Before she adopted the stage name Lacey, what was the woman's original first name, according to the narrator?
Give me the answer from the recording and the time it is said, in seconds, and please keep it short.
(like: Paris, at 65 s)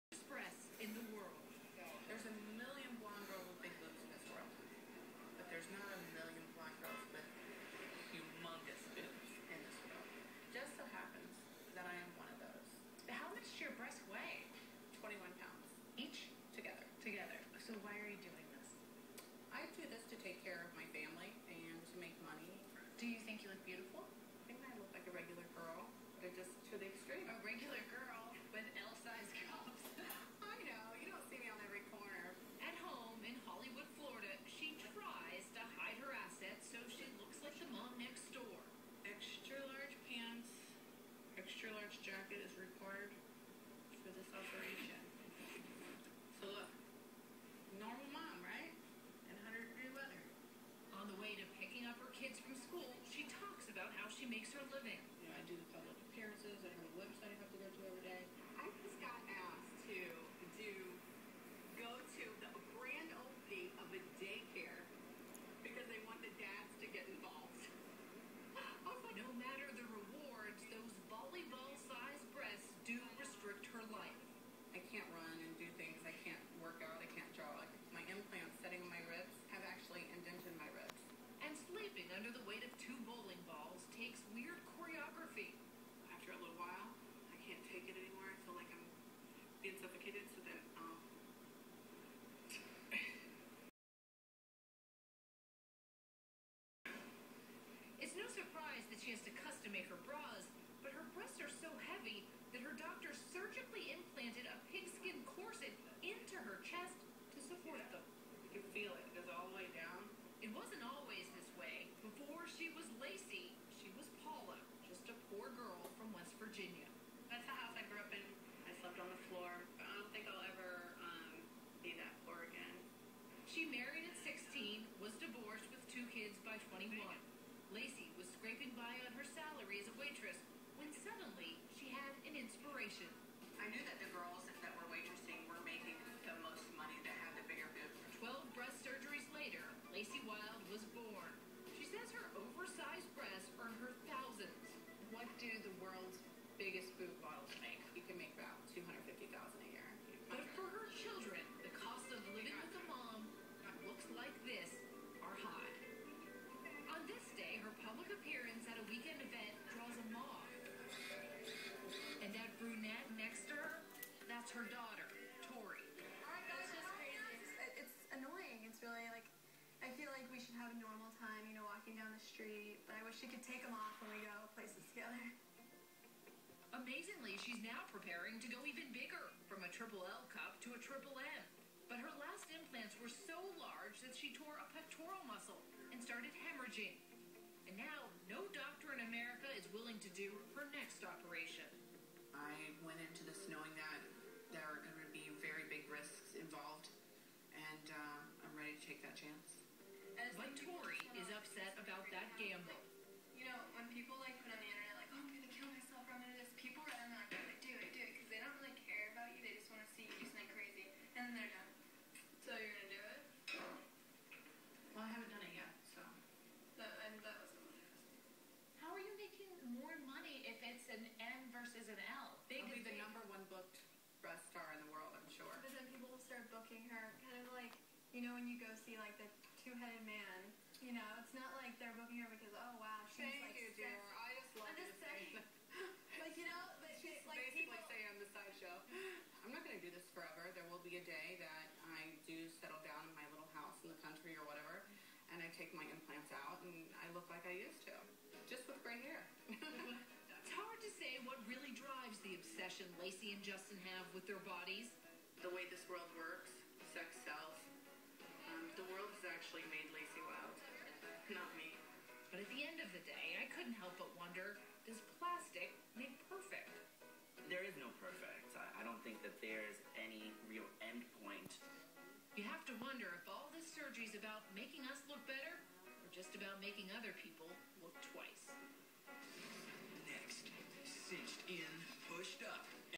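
Paula, at 114 s.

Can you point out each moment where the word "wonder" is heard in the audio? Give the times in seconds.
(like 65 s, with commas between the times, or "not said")
264 s, 272 s.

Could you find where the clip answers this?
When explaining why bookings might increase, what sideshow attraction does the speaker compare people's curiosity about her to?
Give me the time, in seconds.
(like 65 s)
229 s.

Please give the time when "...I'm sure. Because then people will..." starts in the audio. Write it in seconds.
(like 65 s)
225 s.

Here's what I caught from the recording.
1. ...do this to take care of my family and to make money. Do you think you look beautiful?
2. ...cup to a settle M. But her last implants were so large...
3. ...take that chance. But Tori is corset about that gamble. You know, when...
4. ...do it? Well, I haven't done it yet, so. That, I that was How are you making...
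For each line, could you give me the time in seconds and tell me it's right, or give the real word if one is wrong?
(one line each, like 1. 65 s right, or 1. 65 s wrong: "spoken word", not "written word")
1. 19 s right
2. 180 s wrong: "triple", not "settle"
3. 198 s wrong: "upset", not "corset"
4. 212 s right.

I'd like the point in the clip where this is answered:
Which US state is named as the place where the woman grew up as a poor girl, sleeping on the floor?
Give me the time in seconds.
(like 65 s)
116 s.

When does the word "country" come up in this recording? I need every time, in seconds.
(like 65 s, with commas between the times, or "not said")
244 s.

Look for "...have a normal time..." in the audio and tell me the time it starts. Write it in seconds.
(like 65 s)
170 s.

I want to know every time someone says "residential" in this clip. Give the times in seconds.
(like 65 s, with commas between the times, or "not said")
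not said.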